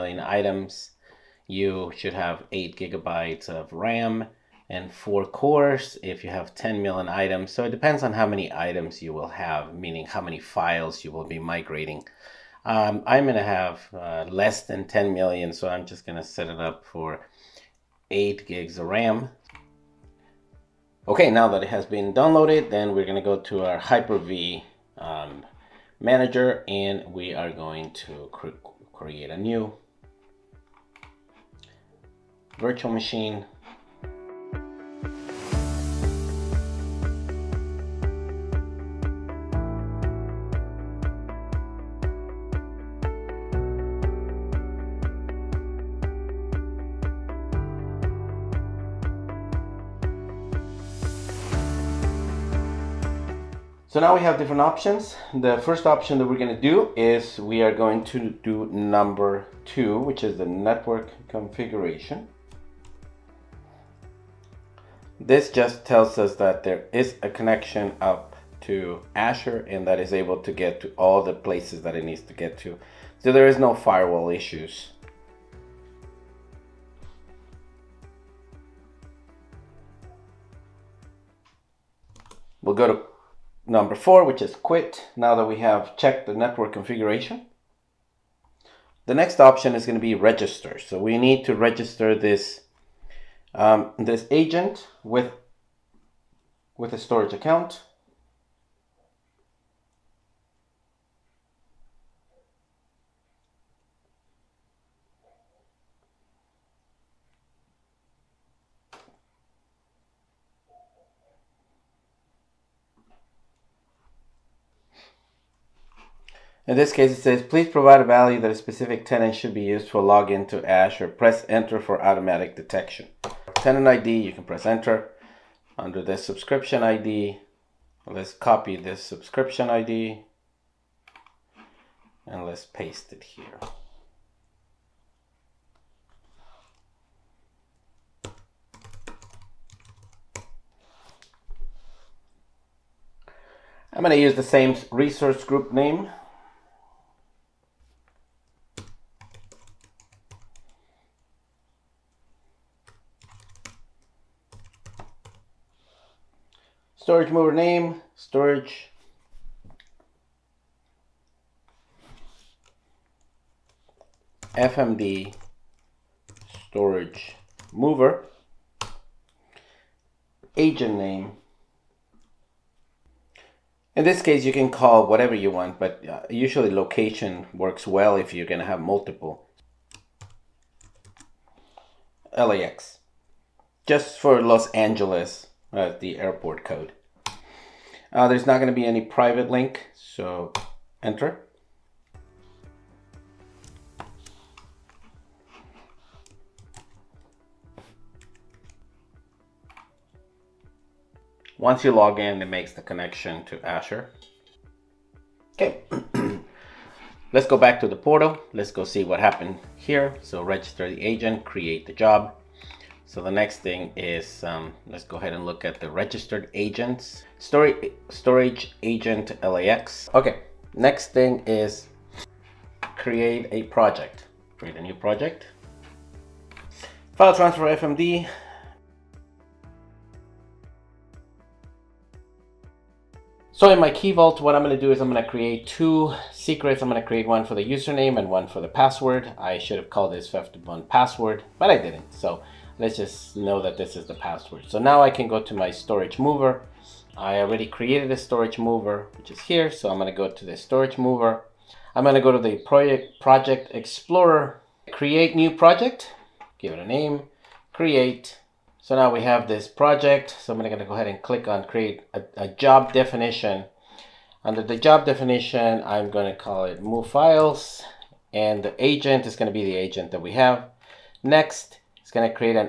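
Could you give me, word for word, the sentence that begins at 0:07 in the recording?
So it depends on how many items you will have, meaning how many files you will be migrating.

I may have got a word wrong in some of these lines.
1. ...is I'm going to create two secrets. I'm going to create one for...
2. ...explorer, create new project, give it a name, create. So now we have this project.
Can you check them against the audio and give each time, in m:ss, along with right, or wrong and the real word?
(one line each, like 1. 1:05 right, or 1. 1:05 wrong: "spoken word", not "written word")
1. 3:54 right
2. 4:13 right.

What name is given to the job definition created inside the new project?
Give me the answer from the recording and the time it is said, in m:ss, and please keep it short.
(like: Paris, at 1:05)
move files, at 4:26.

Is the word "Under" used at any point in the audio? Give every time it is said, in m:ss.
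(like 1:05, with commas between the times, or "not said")
2:05, 4:24.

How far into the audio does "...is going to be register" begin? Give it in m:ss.
1:29.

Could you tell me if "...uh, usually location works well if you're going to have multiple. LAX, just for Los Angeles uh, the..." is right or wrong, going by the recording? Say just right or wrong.
right.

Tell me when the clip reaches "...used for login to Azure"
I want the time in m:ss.
1:59.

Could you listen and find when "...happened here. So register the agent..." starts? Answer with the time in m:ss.
3:29.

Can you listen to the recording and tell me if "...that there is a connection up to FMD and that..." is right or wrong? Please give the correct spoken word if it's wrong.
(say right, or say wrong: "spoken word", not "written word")
wrong: "Azure", not "FMD".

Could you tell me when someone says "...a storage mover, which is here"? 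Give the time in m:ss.
4:08.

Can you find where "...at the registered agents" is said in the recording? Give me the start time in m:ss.
3:35.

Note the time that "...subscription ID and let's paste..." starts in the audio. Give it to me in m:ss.
2:09.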